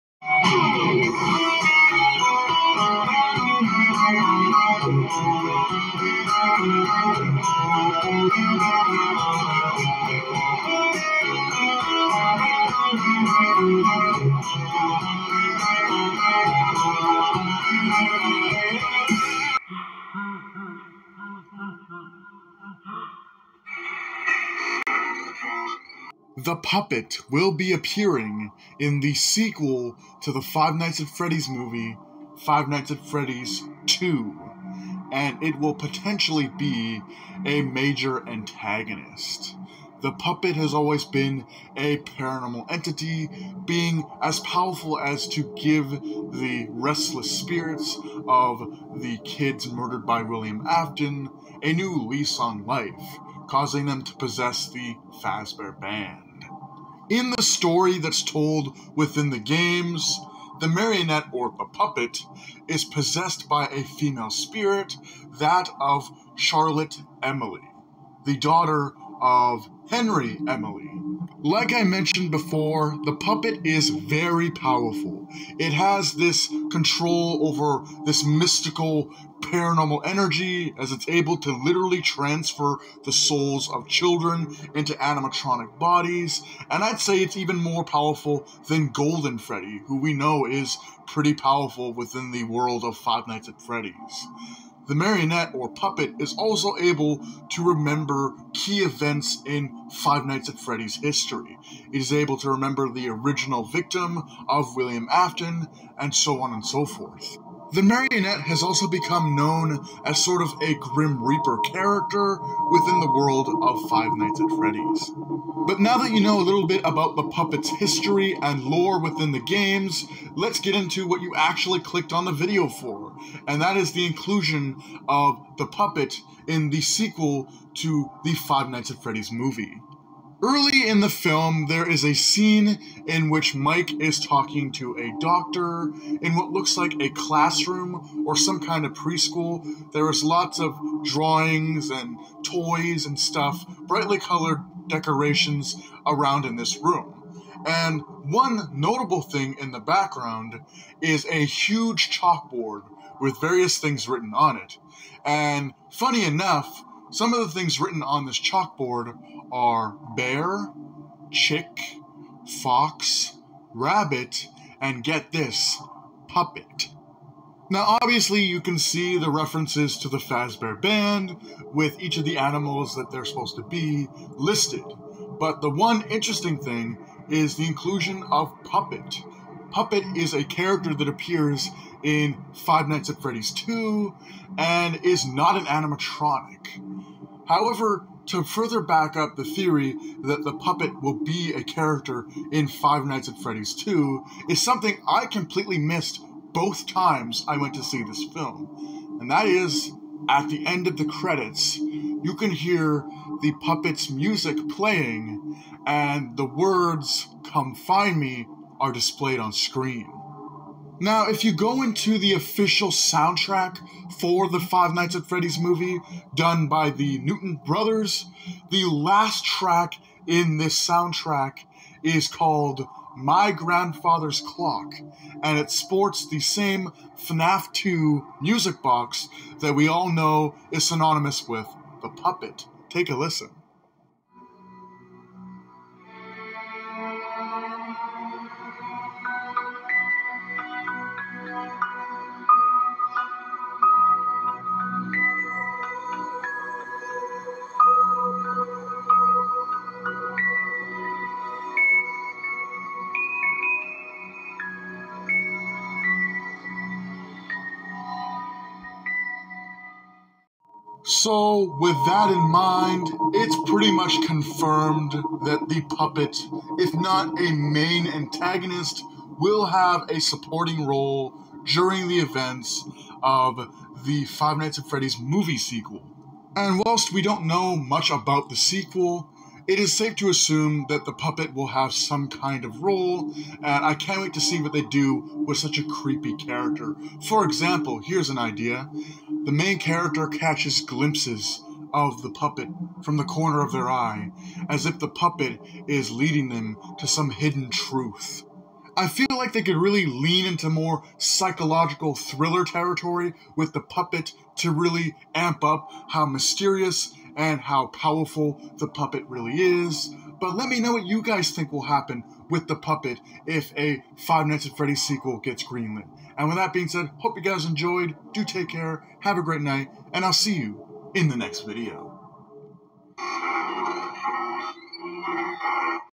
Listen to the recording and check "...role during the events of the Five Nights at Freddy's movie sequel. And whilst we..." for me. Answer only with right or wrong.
right.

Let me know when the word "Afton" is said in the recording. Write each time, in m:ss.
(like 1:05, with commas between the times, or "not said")
0:50, 1:45.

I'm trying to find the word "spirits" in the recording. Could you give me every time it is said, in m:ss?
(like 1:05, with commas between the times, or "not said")
0:47, 1:04.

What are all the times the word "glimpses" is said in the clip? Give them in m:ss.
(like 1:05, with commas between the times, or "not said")
4:50.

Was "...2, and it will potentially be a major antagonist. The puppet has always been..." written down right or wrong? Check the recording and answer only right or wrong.
right.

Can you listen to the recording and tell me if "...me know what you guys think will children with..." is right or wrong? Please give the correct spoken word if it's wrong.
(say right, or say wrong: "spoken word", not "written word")
wrong: "happen", not "children".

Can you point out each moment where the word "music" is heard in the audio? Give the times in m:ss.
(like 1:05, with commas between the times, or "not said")
3:24, 3:48.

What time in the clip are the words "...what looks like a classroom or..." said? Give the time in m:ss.
2:16.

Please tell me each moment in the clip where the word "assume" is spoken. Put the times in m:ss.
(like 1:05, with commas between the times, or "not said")
4:40.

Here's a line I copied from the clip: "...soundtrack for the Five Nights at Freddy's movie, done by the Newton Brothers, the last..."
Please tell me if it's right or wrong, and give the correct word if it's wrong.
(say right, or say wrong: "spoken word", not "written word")
right.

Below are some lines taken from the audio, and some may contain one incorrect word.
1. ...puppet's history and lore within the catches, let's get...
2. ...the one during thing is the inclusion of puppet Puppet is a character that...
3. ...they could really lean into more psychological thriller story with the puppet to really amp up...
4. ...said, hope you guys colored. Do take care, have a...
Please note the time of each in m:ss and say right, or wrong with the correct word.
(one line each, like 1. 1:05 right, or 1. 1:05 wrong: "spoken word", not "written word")
1. 1:57 wrong: "games", not "catches"
2. 2:55 wrong: "interesting", not "during"
3. 4:59 wrong: "territory", not "story"
4. 5:16 wrong: "enjoyed", not "colored".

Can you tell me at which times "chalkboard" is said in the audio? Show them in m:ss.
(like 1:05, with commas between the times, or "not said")
2:32, 2:38.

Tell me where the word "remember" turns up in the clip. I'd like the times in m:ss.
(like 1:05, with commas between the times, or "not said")
1:37, 1:42.